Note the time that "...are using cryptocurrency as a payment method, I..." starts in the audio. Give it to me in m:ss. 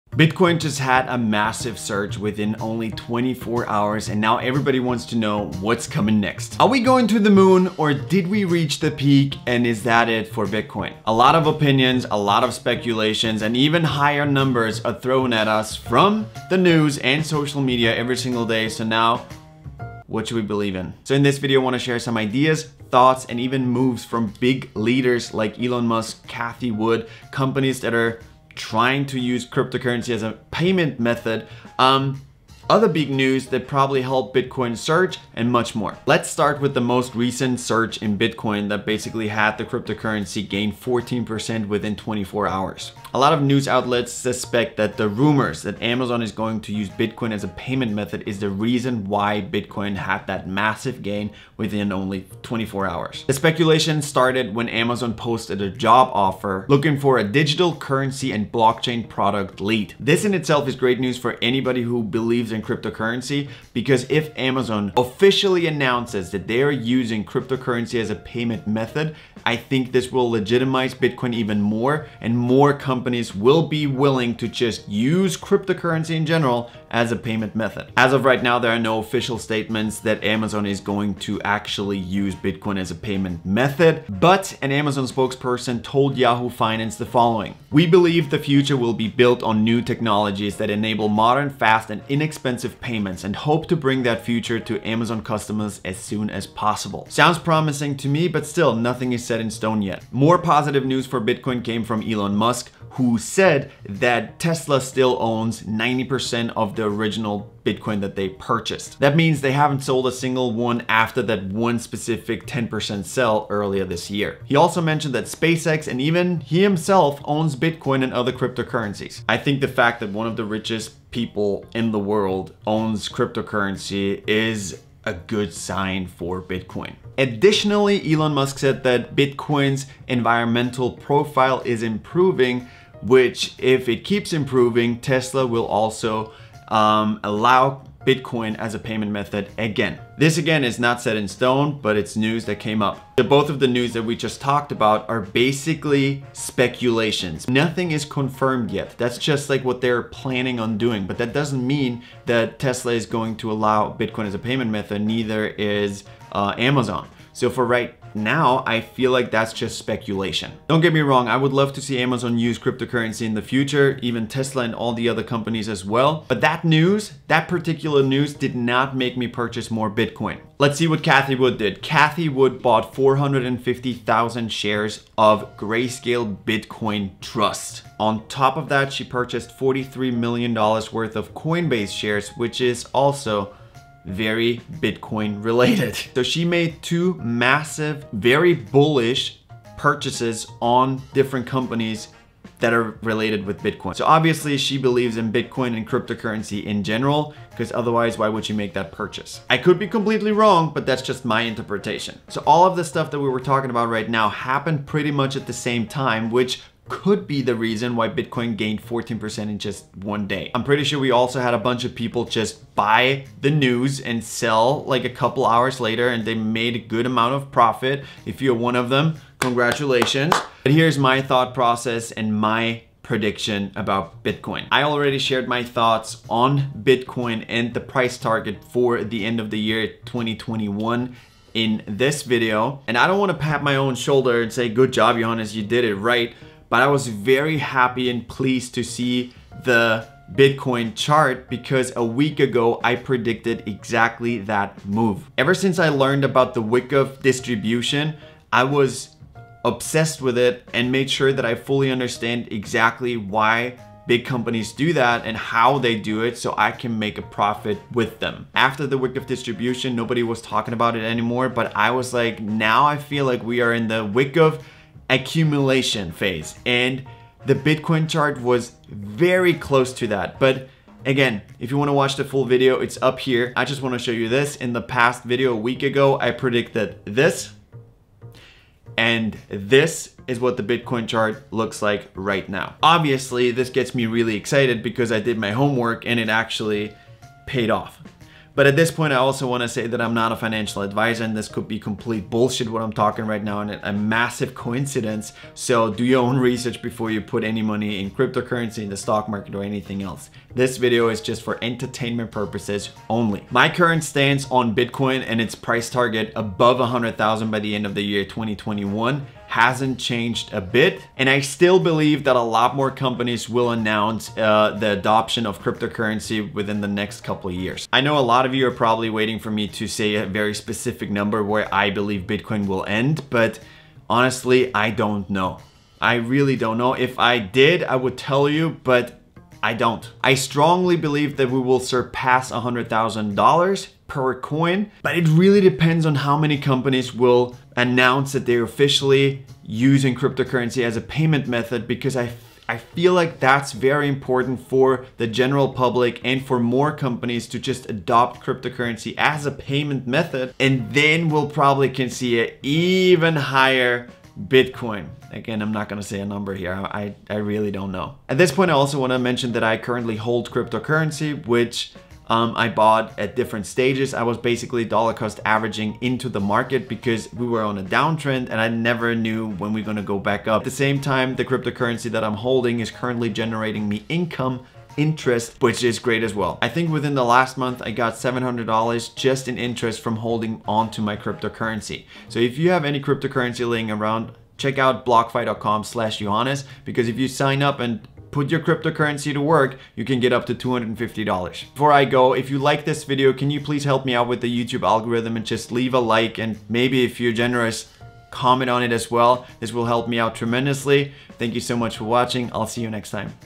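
1:06.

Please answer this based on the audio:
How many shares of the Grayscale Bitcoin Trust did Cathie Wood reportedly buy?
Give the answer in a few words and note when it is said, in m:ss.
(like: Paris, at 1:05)
450,000, at 2:52.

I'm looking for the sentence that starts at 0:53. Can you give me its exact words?
The speculation started when Amazon posted a job offer looking for a digital currency and blockchain product lead.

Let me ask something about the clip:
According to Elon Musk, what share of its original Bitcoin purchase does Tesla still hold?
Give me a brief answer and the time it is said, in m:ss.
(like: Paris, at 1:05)
90%, at 1:45.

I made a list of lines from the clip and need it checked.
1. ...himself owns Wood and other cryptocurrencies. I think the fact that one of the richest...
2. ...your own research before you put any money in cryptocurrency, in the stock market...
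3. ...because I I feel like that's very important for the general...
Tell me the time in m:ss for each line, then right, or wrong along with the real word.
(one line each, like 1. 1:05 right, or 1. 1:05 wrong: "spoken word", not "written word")
1. 1:56 wrong: "Bitcoin", not "Wood"
2. 4:56 right
3. 5:41 right.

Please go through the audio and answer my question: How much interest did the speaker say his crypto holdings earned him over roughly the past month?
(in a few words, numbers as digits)
$700.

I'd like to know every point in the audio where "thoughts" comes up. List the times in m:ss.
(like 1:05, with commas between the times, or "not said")
0:22, 3:41, 3:45.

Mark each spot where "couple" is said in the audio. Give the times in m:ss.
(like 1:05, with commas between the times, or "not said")
3:35, 5:17.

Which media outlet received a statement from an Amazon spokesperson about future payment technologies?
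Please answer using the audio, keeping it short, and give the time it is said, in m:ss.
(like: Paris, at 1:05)
Yahoo Finance, at 1:26.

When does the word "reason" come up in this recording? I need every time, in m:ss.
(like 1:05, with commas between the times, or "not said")
0:48, 3:27.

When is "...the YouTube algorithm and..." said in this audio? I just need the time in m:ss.
6:34.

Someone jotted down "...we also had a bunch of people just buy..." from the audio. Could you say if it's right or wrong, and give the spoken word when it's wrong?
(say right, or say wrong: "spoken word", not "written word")
right.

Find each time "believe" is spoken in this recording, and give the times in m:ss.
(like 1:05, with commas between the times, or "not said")
0:20, 1:02, 1:27, 3:14, 5:11, 5:21, 5:30.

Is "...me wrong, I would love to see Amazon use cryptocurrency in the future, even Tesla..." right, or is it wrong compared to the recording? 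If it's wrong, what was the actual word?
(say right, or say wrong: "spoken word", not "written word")
right.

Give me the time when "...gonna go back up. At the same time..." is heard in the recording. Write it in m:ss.
6:09.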